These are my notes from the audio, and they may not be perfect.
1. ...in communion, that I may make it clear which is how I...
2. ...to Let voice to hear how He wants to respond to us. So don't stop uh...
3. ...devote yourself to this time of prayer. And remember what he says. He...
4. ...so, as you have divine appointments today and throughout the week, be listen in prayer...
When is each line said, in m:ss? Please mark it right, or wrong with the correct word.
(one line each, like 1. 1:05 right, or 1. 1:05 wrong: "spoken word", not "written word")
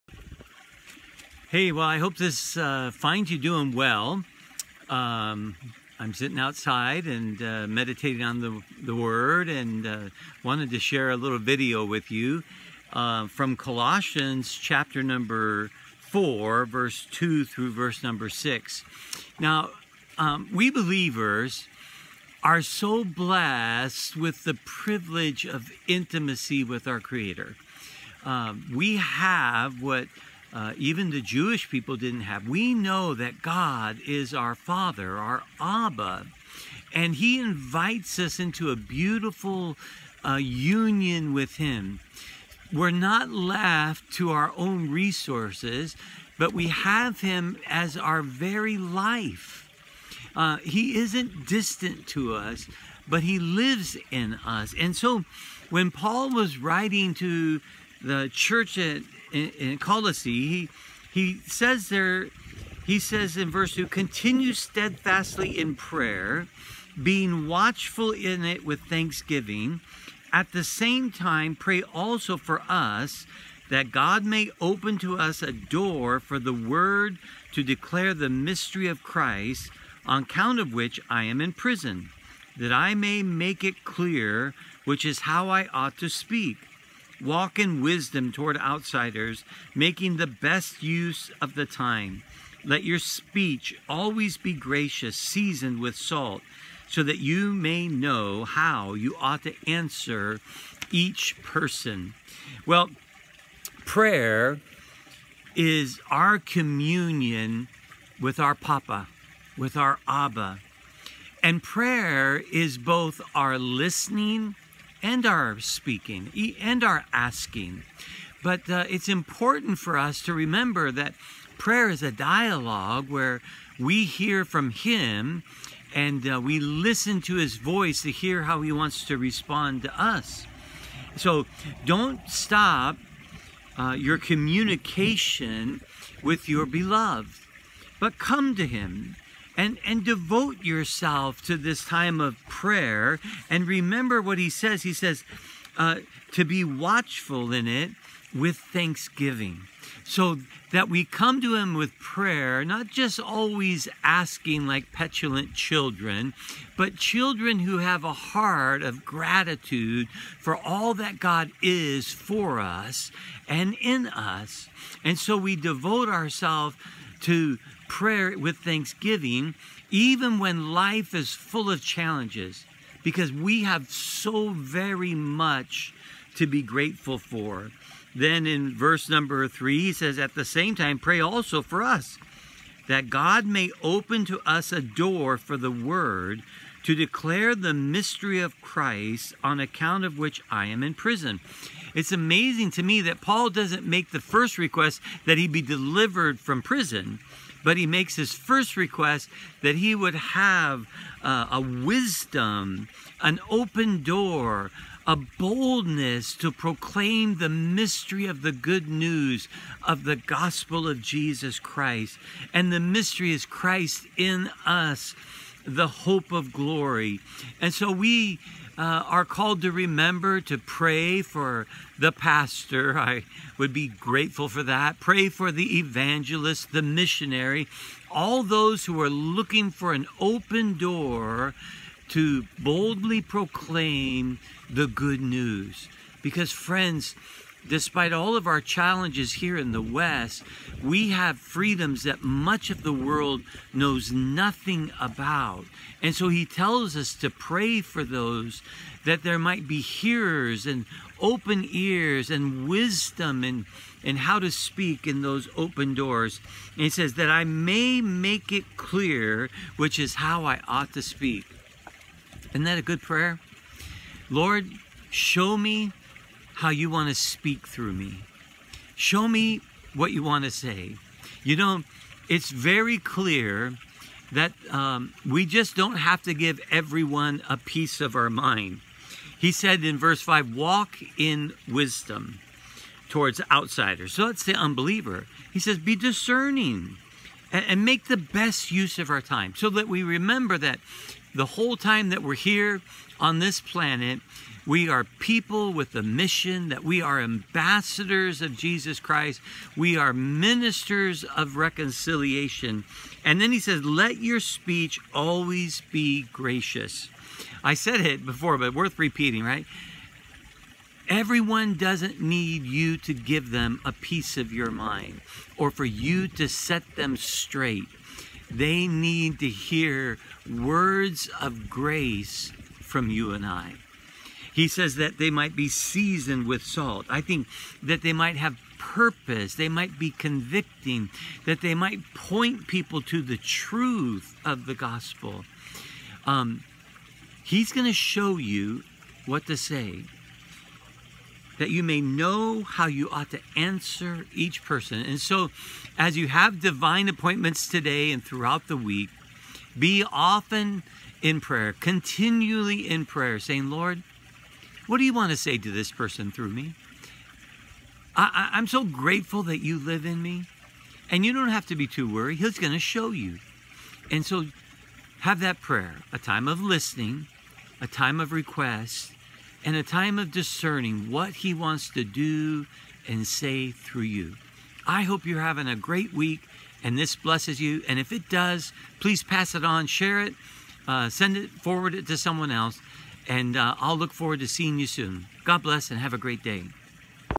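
1. 1:21 wrong: "prison", not "communion"
2. 2:07 wrong: "His", not "Let"
3. 2:20 right
4. 5:45 wrong: "often", not "listen".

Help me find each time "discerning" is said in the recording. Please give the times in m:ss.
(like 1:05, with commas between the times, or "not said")
4:45, 6:10.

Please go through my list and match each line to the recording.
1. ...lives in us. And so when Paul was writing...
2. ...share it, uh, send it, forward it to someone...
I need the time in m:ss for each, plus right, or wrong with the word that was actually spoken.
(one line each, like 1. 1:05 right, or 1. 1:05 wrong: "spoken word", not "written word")
1. 0:53 right
2. 6:19 right.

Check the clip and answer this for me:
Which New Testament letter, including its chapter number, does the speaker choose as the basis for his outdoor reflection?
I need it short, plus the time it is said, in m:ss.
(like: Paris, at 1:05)
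Colossians 4, at 0:13.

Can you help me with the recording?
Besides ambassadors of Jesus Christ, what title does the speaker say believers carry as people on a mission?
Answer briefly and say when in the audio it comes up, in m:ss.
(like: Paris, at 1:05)
ministers of reconciliation, at 5:00.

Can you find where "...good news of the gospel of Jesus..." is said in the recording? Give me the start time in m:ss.
3:28.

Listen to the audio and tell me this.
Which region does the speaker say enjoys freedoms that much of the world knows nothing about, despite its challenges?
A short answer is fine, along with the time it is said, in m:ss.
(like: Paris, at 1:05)
the West, at 3:59.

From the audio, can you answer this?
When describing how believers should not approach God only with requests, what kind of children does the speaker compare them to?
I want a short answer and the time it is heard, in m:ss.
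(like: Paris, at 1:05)
petulant children, at 2:34.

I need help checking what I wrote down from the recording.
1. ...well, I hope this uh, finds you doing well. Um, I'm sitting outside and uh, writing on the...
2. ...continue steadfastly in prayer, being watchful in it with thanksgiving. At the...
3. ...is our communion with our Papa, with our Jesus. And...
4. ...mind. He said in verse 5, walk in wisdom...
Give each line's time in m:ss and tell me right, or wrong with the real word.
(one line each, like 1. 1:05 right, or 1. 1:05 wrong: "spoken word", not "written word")
1. 0:01 wrong: "meditating", not "writing"
2. 1:03 right
3. 1:45 wrong: "Abba", not "Jesus"
4. 4:38 right.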